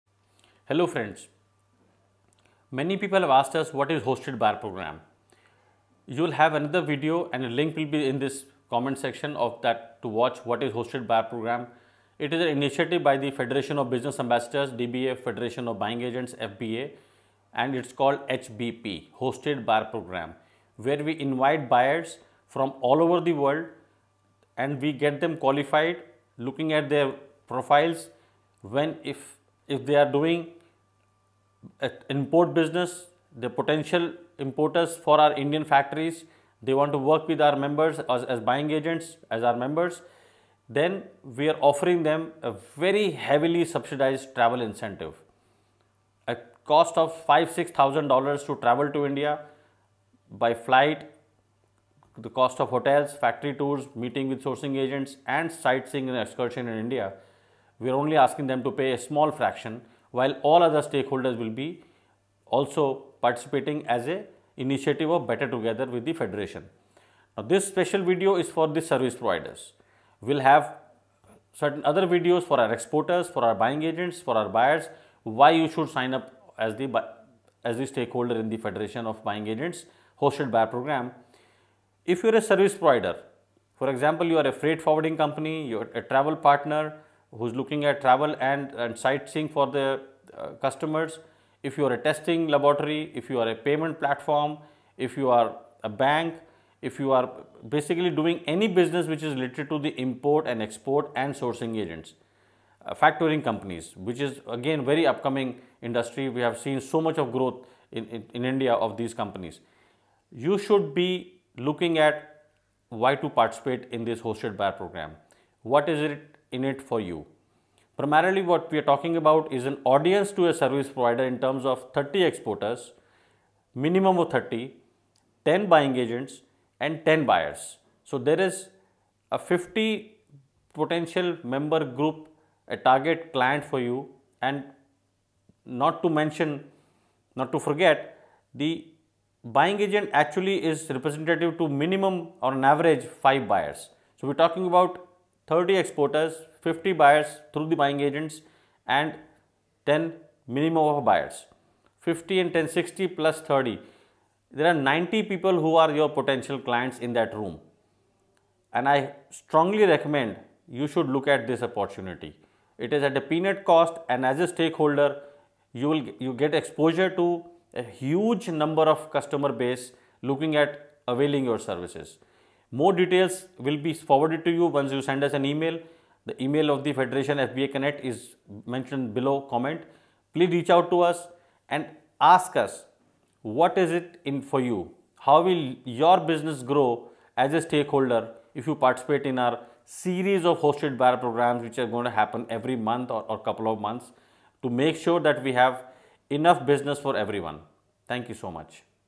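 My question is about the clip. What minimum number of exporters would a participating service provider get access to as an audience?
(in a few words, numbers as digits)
30.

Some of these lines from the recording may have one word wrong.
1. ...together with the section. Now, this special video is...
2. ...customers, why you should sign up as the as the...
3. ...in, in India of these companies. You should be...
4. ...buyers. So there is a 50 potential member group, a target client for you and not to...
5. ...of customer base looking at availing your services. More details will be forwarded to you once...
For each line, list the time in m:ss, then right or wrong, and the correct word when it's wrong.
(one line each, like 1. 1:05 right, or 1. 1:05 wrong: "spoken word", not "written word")
1. 1:05 wrong: "federation", not "section"
2. 1:14 wrong: "buyers", not "customers"
3. 1:48 right
4. 2:07 right
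5. 2:48 right.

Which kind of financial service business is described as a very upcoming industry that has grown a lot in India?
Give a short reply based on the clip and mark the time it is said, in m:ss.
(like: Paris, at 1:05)
Factoring companies, at 1:42.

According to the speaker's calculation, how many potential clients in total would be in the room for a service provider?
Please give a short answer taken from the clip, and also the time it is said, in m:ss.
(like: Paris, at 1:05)
90, at 2:34.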